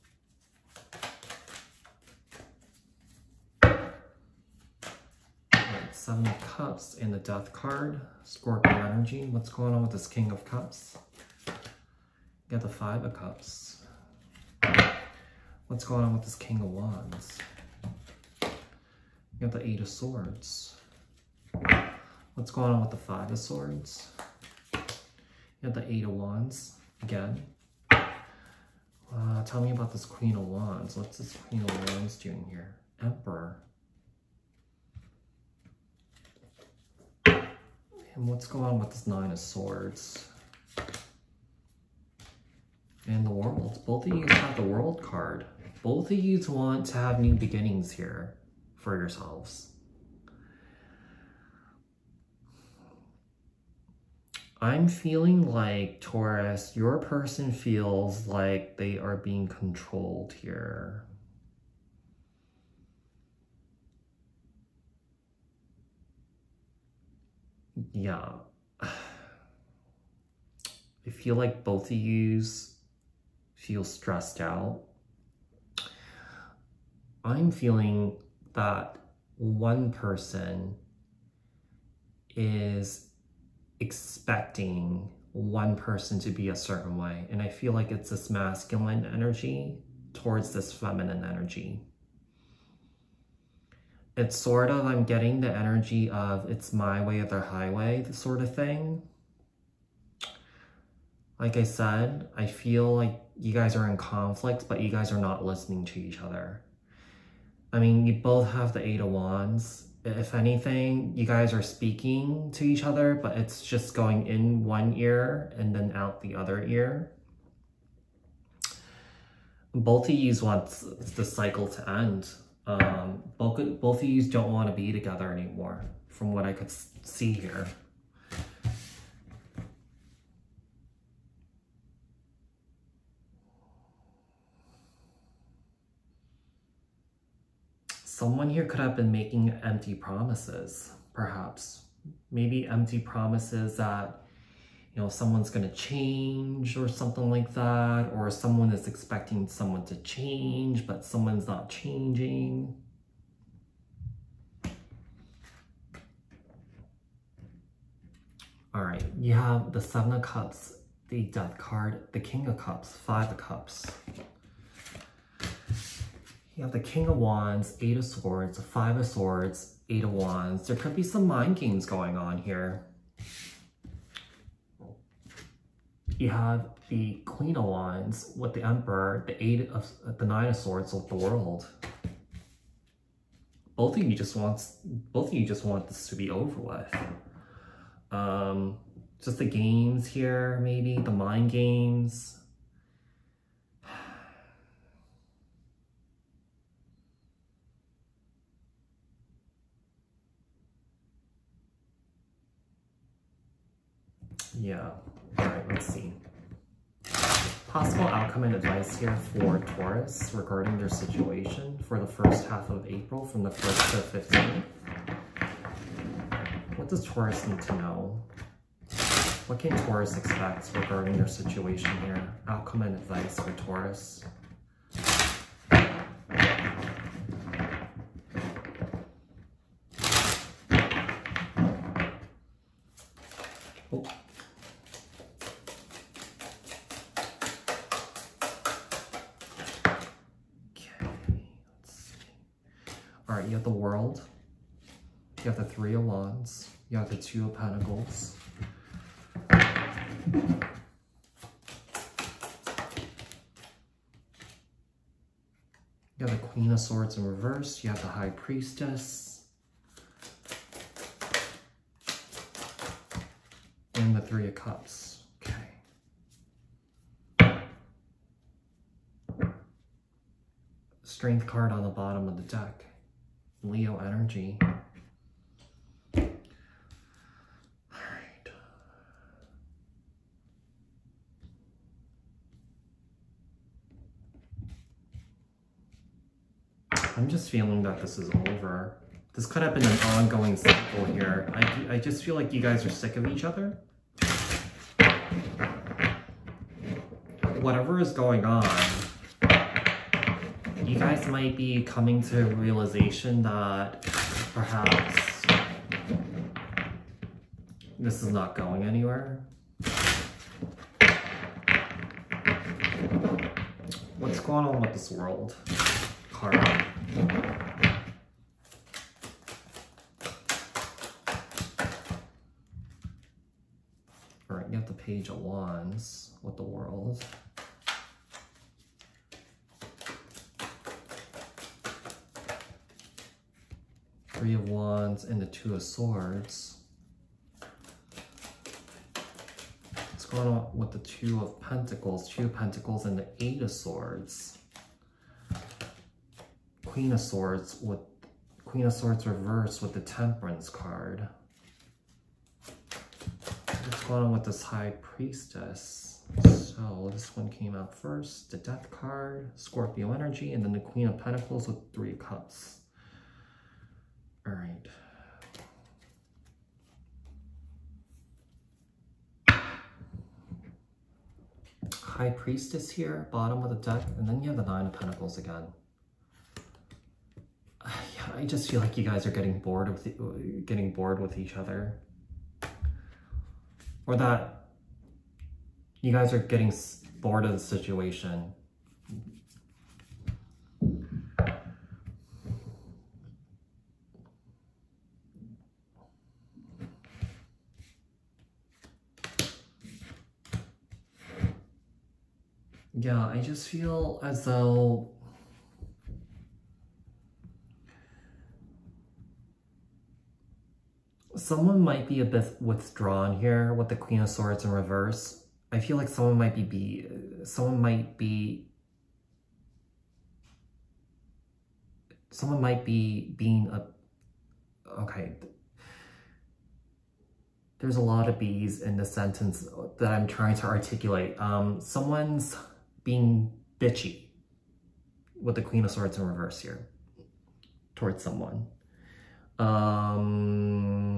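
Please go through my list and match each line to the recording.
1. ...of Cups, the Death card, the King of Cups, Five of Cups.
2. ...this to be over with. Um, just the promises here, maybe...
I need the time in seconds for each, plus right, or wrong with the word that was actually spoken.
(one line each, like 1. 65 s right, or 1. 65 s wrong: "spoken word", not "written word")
1. 160 s right
2. 185 s wrong: "games", not "promises".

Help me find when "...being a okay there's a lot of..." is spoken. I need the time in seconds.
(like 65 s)
423 s.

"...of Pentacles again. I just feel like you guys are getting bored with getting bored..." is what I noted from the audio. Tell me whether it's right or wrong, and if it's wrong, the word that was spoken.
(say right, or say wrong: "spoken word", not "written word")
right.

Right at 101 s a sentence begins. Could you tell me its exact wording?
Like I said, I feel like you guys are in conflict, but you guys are not listening to each other.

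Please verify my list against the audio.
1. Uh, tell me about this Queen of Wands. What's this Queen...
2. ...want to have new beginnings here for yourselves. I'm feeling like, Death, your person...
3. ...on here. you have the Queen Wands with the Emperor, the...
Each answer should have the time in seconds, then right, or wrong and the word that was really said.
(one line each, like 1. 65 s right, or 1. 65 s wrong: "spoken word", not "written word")
1. 27 s right
2. 46 s wrong: "Taurus", not "Death"
3. 172 s right.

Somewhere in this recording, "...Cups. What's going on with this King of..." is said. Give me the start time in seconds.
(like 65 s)
13 s.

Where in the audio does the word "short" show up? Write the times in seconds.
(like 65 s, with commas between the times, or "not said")
not said.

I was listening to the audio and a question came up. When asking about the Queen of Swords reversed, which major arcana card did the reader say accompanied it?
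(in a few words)
Temperance.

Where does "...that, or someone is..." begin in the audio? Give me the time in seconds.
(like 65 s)
147 s.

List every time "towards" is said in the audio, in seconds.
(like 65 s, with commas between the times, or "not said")
90 s, 437 s.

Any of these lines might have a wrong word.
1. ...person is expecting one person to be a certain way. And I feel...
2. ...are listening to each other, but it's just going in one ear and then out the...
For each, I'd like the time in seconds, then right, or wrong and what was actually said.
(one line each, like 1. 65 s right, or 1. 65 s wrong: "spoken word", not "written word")
1. 79 s right
2. 111 s wrong: "speaking", not "listening".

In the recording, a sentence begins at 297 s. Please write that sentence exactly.
Whatever is going on, you guys might be coming to a realization that perhaps this is not going anywhere.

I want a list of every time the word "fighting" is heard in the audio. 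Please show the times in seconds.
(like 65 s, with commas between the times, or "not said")
not said.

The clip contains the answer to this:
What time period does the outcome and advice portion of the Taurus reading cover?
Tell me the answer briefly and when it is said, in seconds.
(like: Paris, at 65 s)
April 1st to 15th, at 213 s.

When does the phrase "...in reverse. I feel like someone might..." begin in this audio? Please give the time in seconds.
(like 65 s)
414 s.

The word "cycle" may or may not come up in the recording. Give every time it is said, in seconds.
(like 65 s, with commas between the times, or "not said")
121 s, 290 s.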